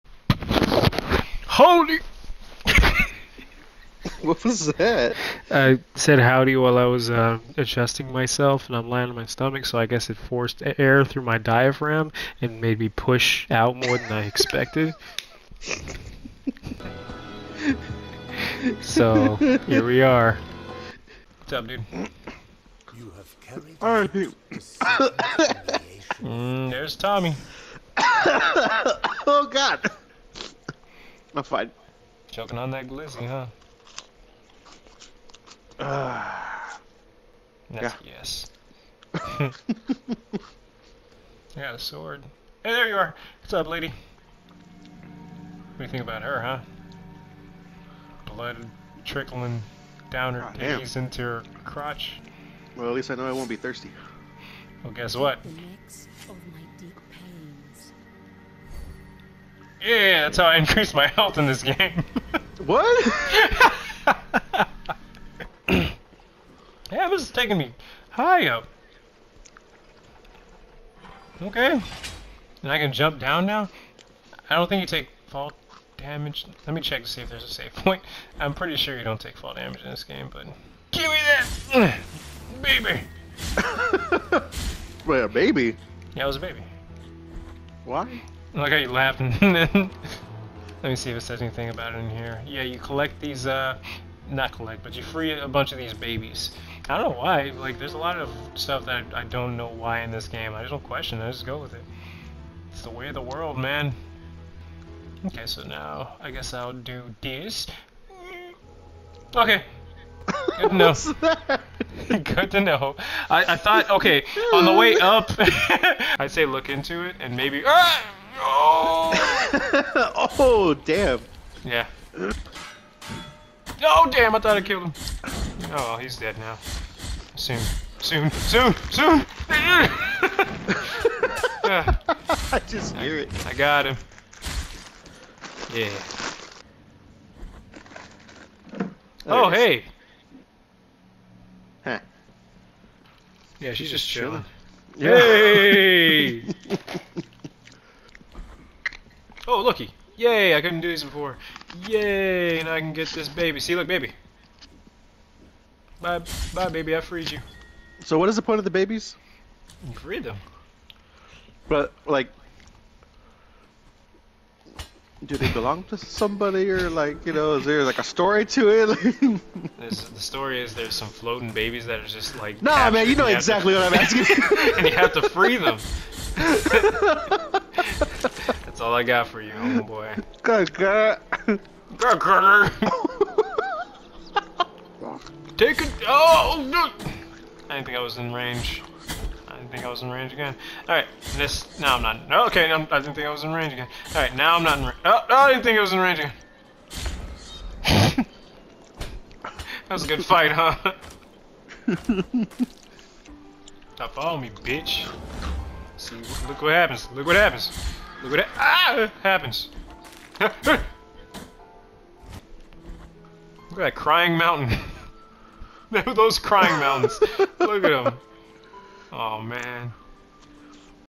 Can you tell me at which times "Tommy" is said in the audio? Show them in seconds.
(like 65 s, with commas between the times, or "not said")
26 s.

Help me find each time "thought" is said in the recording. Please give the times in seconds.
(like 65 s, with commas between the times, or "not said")
113 s, 124 s.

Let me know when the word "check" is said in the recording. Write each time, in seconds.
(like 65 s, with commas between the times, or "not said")
76 s.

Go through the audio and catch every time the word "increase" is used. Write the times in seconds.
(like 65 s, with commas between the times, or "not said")
60 s.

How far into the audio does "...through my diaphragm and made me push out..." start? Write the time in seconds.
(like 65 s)
11 s.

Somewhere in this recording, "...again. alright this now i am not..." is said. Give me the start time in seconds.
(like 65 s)
193 s.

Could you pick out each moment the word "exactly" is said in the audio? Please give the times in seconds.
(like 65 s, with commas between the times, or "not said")
173 s.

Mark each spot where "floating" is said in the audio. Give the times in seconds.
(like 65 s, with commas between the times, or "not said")
171 s.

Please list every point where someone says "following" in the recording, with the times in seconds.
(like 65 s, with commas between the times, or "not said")
204 s.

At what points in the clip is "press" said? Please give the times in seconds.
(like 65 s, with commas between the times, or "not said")
not said.